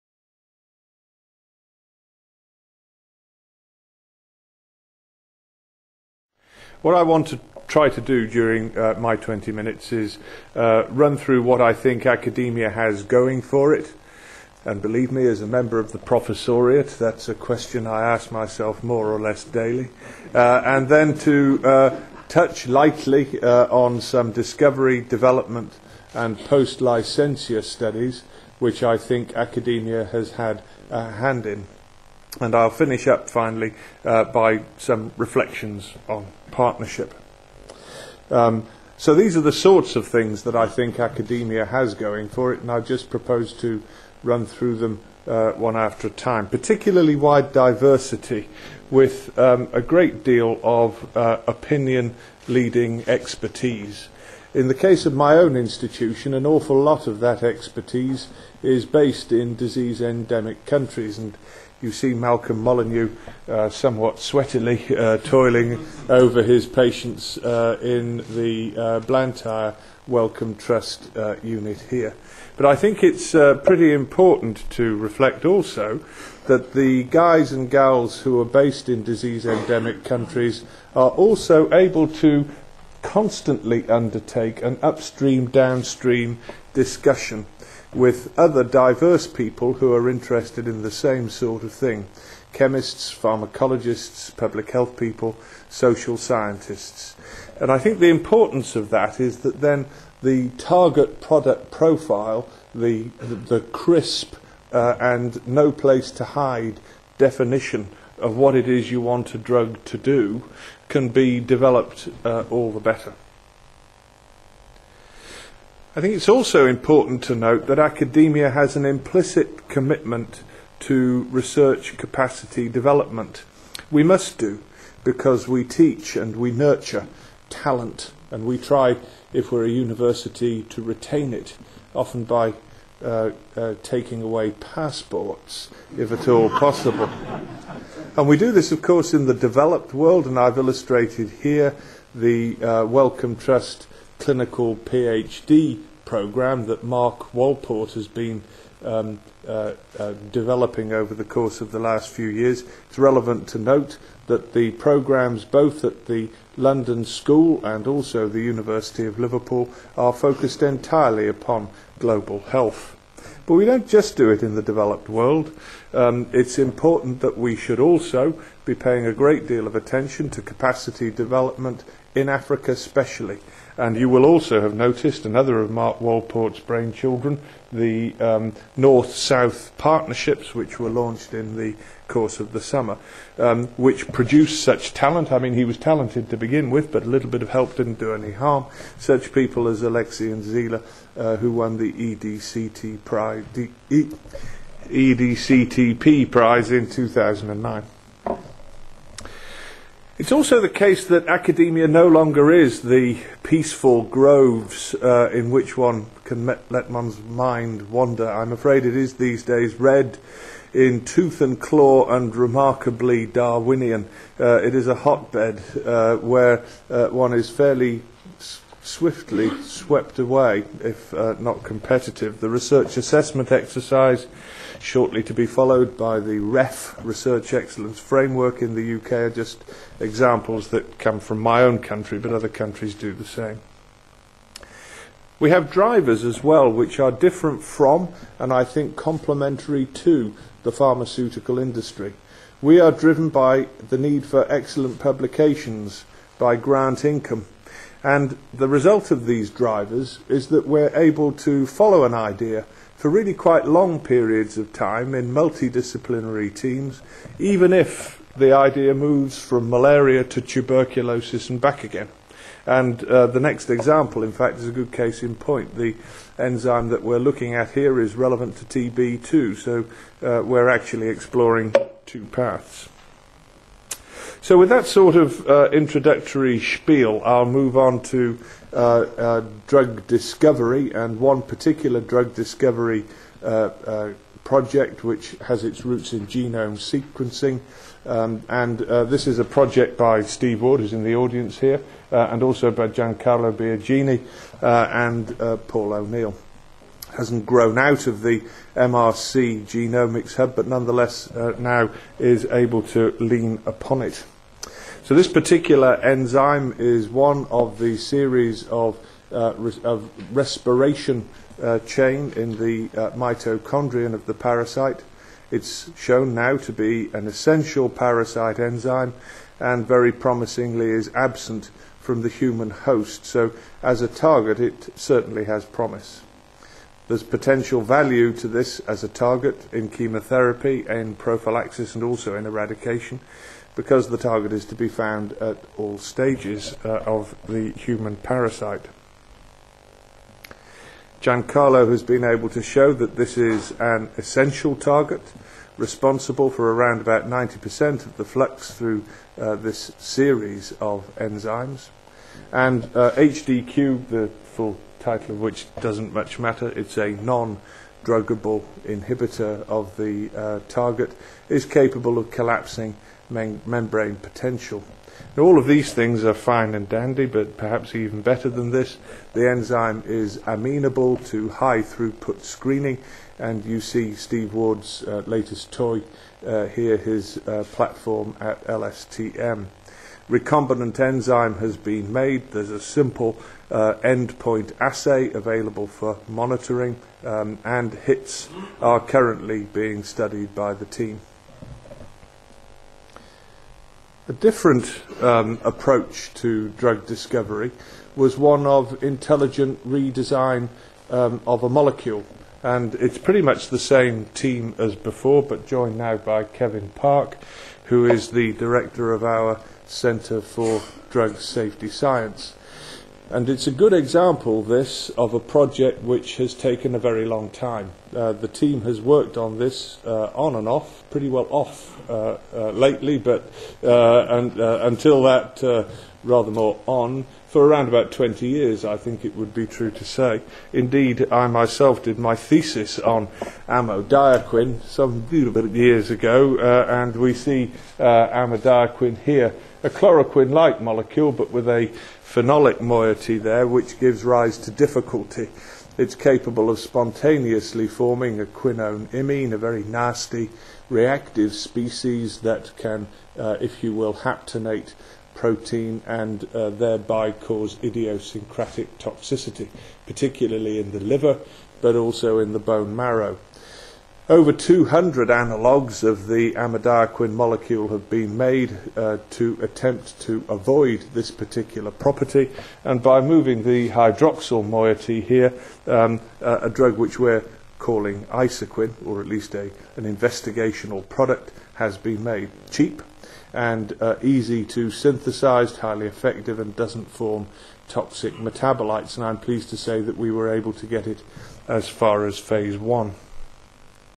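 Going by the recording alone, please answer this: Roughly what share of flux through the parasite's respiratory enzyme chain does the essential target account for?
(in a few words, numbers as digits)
90%.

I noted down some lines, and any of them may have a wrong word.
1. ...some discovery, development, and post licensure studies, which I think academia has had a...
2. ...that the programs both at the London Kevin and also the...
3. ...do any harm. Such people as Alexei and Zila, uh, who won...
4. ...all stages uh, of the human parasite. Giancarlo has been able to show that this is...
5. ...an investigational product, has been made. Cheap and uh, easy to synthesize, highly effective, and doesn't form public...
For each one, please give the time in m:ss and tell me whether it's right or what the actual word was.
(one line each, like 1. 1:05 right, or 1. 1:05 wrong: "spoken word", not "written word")
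1. 0:24 right
2. 2:34 wrong: "School", not "Kevin"
3. 3:07 right
4. 5:35 right
5. 7:59 wrong: "toxic", not "public".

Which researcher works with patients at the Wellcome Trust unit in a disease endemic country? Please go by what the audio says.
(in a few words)
Malcolm Molyneux.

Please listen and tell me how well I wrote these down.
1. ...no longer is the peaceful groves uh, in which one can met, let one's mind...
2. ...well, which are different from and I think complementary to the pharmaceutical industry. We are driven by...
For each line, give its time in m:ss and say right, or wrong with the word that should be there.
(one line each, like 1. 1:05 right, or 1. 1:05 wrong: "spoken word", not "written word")
1. 3:21 right
2. 3:56 right.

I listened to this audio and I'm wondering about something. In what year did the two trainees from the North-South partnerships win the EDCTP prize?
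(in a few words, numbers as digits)
2009.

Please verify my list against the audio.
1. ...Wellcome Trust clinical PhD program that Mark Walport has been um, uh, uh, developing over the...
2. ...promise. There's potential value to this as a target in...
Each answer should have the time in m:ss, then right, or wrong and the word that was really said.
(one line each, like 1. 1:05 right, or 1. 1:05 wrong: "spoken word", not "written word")
1. 2:22 right
2. 5:25 right.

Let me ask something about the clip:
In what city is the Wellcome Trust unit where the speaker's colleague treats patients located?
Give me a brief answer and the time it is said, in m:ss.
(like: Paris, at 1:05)
Blantyre, at 1:08.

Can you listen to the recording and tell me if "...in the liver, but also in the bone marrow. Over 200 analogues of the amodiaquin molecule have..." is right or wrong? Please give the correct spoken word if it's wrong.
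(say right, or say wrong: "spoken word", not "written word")
right.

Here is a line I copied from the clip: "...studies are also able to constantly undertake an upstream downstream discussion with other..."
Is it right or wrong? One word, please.
wrong.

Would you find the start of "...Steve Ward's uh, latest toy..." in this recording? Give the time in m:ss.
6:14.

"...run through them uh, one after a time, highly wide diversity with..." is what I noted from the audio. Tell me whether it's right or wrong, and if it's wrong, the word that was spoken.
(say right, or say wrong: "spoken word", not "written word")
wrong: "particularly", not "highly".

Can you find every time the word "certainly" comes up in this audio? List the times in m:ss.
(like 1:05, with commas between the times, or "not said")
5:24.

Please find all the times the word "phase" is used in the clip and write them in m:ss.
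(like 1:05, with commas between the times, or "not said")
8:12.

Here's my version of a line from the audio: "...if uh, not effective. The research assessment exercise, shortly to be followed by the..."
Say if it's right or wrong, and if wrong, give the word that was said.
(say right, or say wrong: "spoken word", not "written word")
wrong: "competitive", not "effective".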